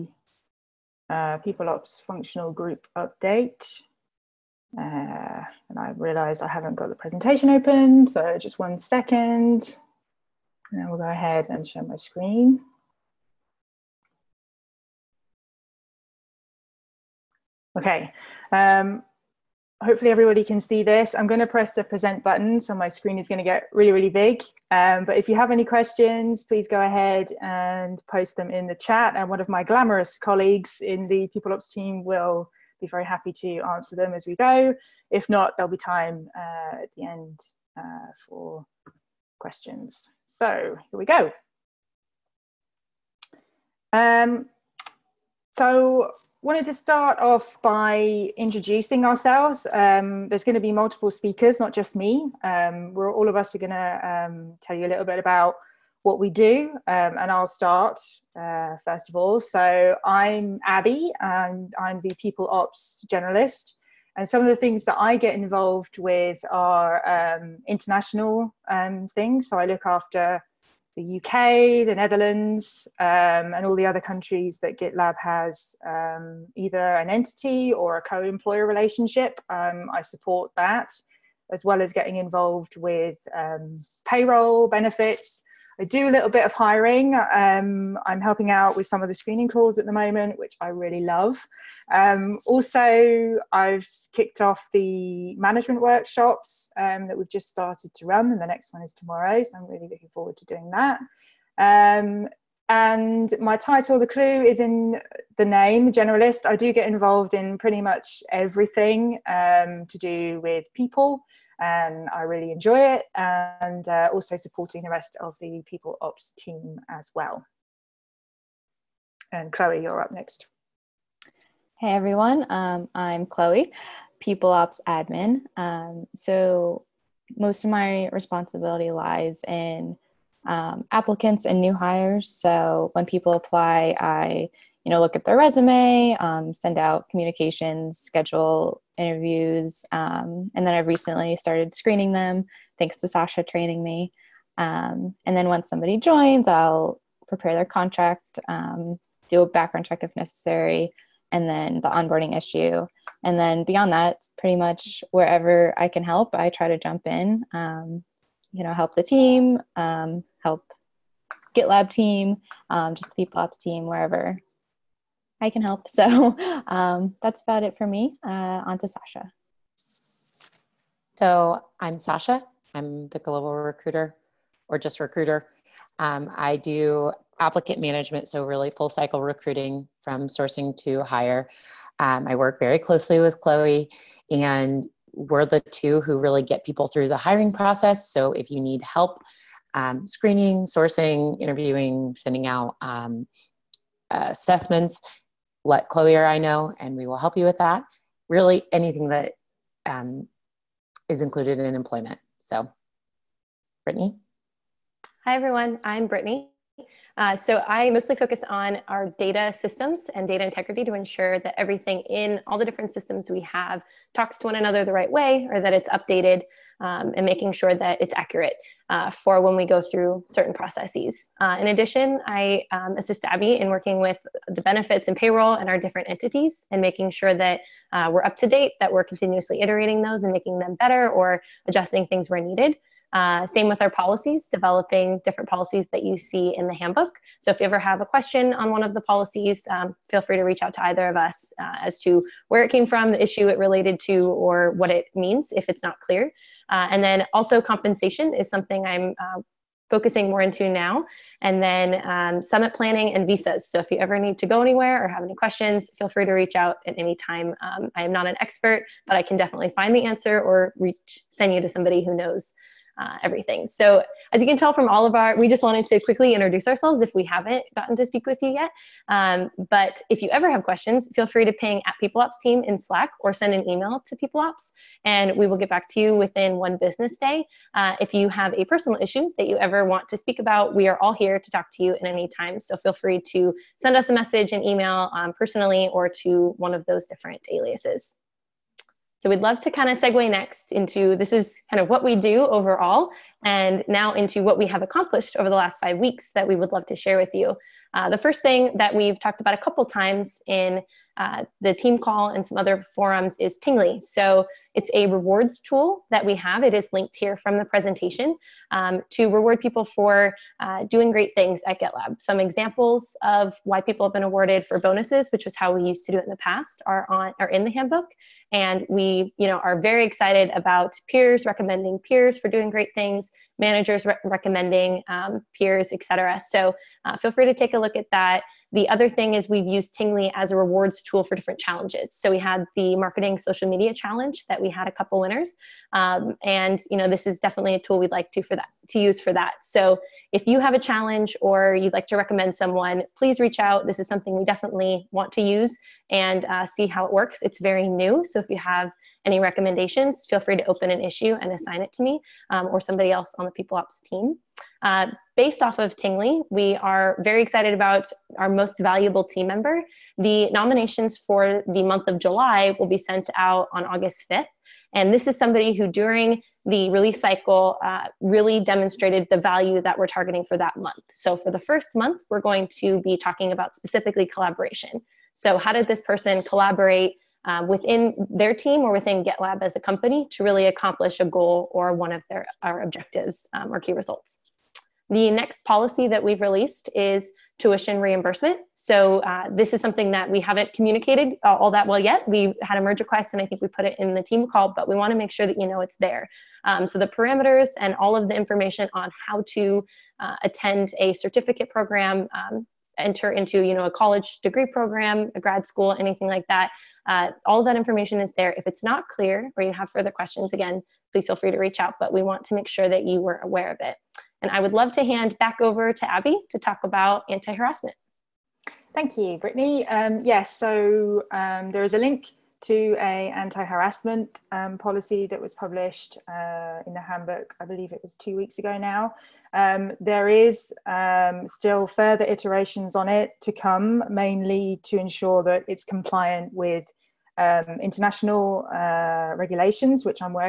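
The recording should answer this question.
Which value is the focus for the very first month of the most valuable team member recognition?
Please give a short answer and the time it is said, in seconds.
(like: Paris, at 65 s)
collaboration, at 374 s.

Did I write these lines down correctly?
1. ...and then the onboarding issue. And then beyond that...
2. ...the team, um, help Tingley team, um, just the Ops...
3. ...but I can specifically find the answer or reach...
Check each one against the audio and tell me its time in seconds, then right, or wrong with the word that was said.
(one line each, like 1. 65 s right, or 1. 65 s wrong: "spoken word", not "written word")
1. 151 s right
2. 158 s wrong: "GitLab", not "Tingley"
3. 259 s wrong: "definitely", not "specifically".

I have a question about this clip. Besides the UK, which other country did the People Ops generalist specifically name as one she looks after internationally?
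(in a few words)
the Netherlands.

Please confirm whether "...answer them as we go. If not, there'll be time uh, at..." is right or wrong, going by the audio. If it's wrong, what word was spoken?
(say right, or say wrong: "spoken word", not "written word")
right.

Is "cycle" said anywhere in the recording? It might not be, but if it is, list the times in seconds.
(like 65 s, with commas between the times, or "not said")
178 s, 367 s.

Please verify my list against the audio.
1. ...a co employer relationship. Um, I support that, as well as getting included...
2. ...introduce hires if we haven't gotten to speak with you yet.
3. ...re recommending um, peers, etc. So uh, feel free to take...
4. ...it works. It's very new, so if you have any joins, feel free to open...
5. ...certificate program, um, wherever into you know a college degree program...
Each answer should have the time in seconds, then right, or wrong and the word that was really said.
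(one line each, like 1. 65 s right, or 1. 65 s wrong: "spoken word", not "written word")
1. 77 s wrong: "involved", not "included"
2. 266 s wrong: "ourselves", not "hires"
3. 324 s right
4. 347 s wrong: "recommendations", not "joins"
5. 401 s wrong: "enter", not "wherever".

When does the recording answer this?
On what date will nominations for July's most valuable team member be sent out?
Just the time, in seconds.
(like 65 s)
363 s.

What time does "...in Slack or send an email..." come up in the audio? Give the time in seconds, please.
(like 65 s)
272 s.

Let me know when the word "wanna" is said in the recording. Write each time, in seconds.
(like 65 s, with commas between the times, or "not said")
394 s.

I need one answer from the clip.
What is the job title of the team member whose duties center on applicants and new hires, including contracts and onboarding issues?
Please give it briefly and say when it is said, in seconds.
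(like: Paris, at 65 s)
People Ops admin, at 124 s.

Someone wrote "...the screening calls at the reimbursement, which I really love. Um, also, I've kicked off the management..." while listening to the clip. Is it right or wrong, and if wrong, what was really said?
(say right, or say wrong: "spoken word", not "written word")
wrong: "moment", not "reimbursement".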